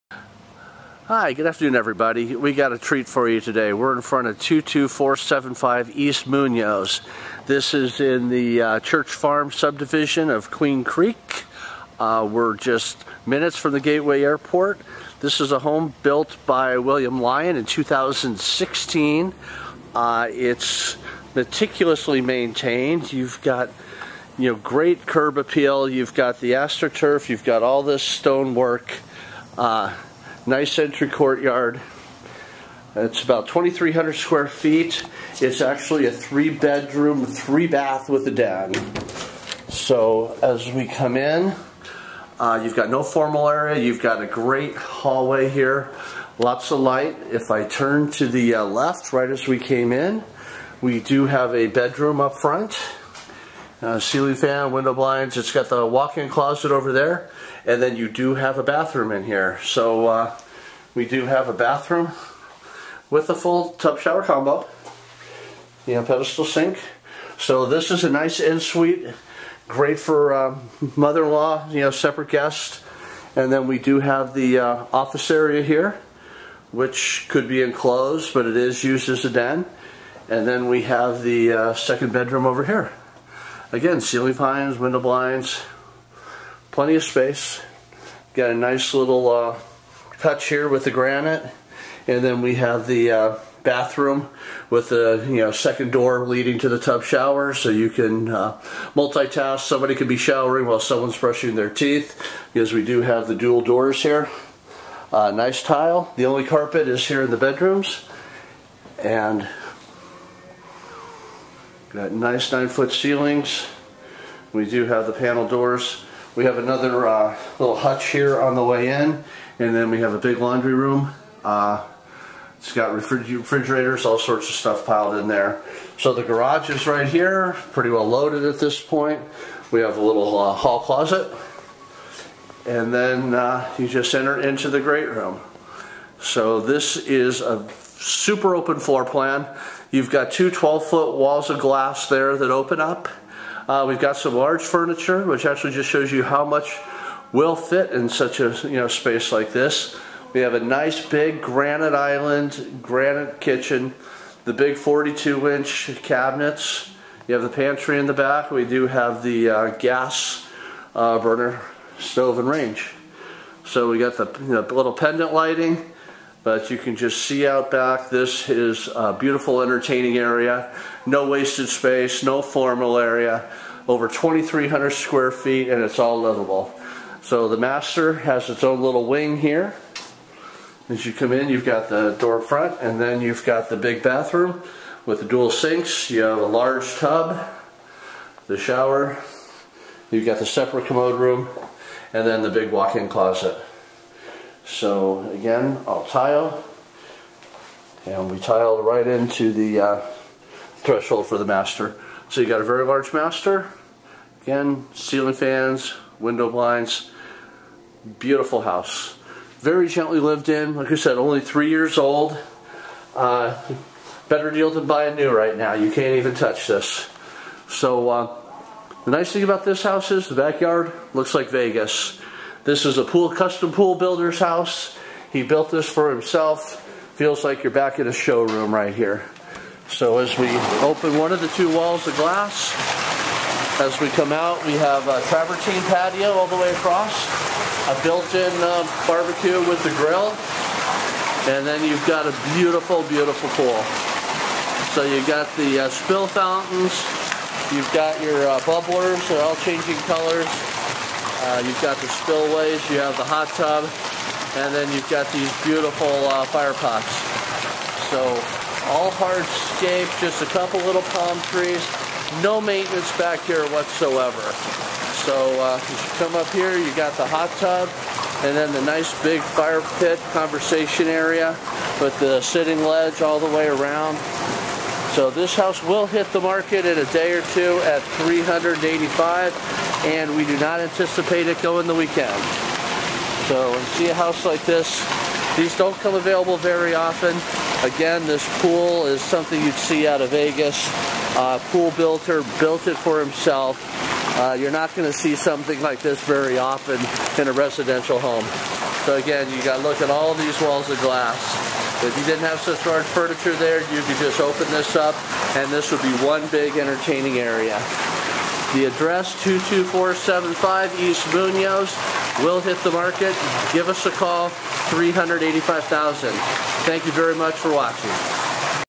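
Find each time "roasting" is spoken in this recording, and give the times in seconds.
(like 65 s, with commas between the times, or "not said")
not said.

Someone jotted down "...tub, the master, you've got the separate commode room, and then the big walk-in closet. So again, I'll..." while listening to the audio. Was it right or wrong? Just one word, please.
wrong.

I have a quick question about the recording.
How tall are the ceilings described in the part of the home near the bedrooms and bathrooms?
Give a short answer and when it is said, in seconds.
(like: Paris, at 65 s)
9 feet, at 112 s.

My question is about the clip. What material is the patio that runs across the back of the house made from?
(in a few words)
travertine.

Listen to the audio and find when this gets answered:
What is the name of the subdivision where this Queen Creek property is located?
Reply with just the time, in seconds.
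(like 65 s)
8 s.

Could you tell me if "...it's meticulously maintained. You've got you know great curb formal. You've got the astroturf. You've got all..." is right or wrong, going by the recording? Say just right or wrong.
wrong.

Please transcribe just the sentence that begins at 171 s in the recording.
No wasted space, no formal area.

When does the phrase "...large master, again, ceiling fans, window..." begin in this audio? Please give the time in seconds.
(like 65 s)
202 s.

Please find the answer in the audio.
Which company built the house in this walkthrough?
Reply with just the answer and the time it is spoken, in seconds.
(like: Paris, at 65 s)
William Lyon, at 16 s.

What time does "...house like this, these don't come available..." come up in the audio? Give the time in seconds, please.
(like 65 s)
284 s.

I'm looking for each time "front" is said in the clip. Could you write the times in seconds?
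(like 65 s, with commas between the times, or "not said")
4 s, 52 s, 182 s.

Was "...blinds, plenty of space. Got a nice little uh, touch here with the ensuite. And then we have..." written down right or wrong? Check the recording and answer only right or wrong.
wrong.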